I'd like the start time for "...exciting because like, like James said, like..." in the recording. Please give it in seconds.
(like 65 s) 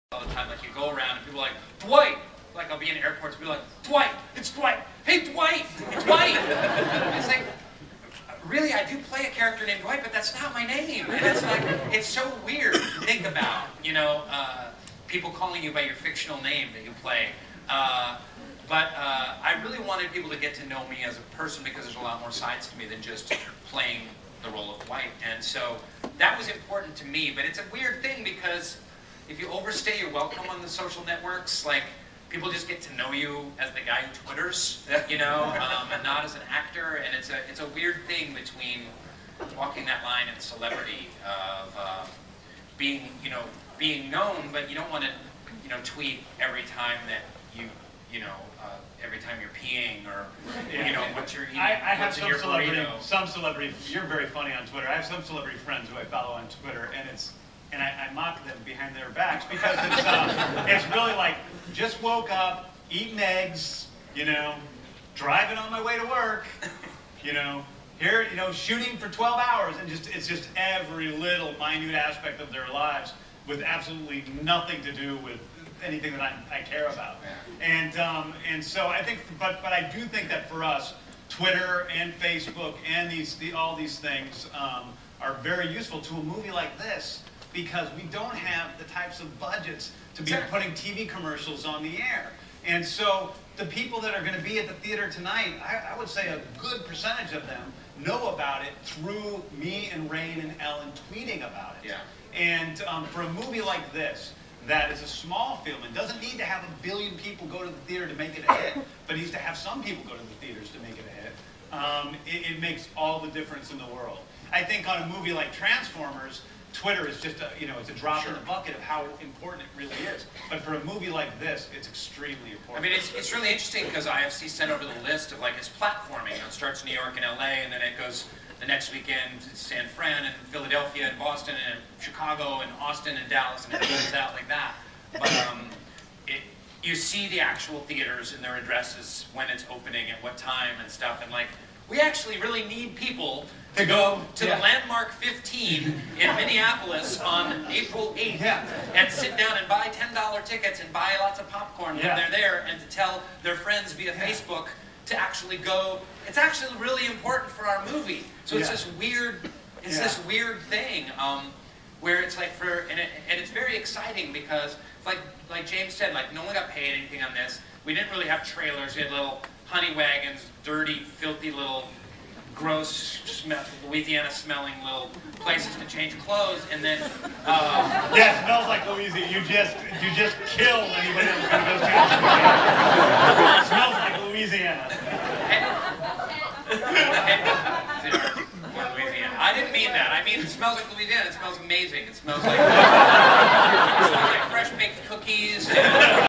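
163 s.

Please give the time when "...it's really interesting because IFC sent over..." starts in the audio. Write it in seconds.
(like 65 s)
123 s.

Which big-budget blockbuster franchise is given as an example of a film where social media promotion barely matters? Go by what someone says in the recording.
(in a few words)
Transformers.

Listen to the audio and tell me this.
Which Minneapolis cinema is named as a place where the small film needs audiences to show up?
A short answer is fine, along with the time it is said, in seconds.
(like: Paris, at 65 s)
Landmark 15, at 144 s.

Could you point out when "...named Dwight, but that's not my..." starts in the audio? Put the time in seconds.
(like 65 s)
9 s.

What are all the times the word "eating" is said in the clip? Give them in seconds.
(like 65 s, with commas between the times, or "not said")
51 s, 62 s.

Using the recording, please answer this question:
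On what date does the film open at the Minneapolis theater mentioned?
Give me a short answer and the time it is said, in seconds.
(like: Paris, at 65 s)
April 8th, at 147 s.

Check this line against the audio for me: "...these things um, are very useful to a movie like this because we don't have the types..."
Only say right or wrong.
right.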